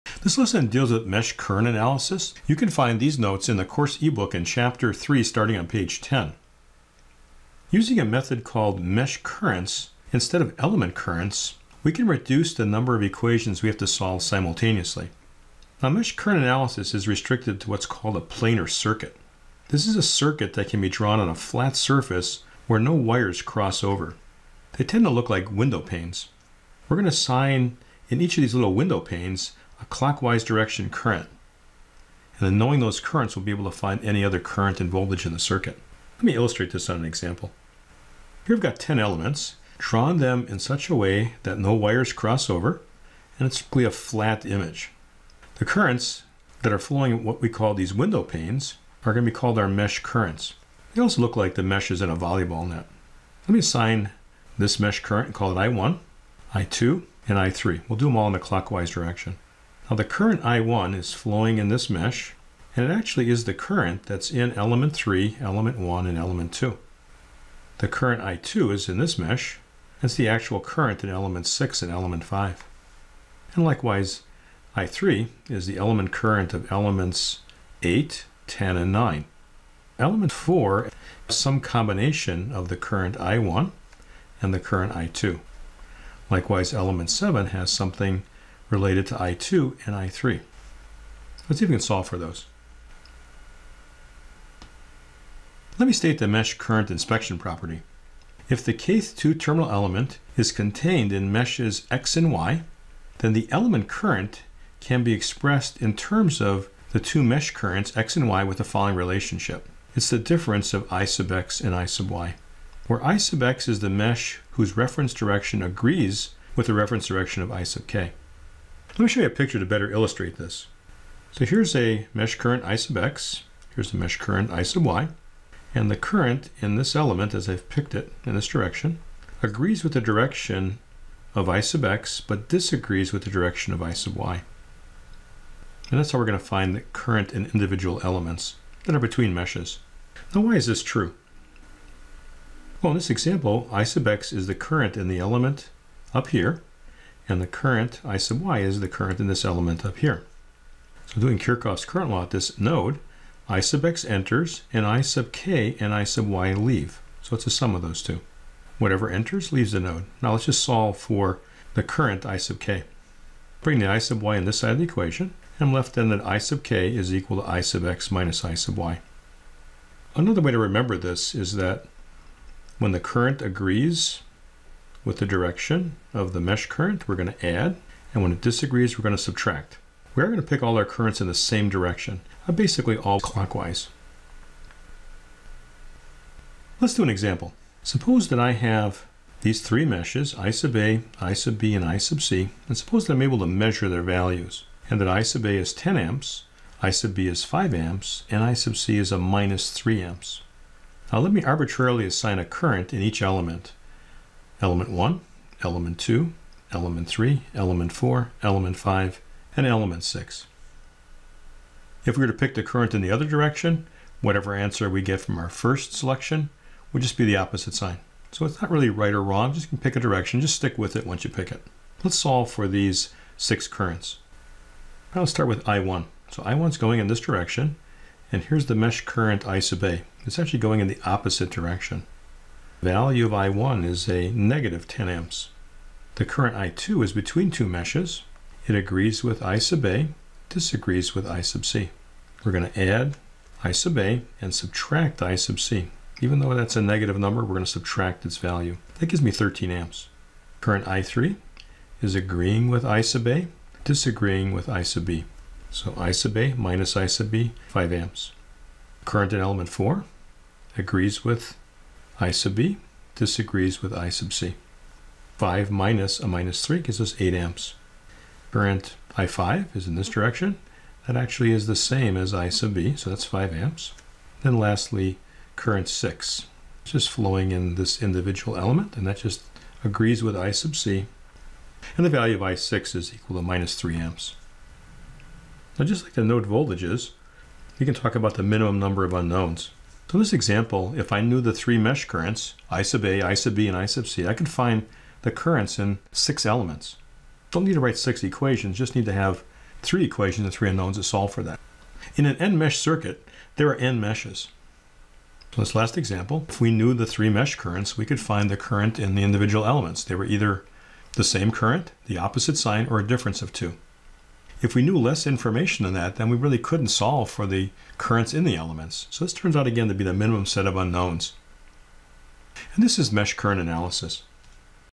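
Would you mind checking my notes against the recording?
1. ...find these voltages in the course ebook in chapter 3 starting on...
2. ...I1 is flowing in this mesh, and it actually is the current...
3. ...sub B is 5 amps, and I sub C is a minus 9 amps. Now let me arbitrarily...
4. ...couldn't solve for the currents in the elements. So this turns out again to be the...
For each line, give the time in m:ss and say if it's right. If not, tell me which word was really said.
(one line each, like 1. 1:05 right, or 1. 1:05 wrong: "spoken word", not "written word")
1. 0:02 wrong: "notes", not "voltages"
2. 1:00 right
3. 3:16 wrong: "3", not "9"
4. 5:16 right.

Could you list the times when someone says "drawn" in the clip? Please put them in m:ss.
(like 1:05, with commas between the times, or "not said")
0:20, 0:39.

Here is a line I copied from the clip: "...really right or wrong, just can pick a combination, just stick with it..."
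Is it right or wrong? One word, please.
wrong.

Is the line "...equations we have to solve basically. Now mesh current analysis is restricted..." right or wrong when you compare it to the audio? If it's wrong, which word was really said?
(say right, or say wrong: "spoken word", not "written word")
wrong: "simultaneously", not "basically".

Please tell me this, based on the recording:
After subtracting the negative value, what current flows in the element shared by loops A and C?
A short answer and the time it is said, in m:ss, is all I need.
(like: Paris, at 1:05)
13 amps, at 4:09.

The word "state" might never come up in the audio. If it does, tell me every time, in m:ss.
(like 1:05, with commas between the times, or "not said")
1:35.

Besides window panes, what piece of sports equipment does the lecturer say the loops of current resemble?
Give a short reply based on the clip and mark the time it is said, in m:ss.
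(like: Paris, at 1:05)
a volleyball net, at 0:52.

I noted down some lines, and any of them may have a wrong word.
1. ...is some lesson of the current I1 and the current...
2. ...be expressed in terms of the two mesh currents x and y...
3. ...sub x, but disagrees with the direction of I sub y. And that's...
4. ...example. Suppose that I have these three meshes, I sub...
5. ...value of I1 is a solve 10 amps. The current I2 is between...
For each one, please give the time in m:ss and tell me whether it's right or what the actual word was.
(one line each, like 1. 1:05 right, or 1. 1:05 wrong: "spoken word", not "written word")
1. 1:21 wrong: "combination", not "lesson"
2. 1:45 right
3. 2:11 right
4. 3:07 right
5. 3:52 wrong: "negative", not "solve".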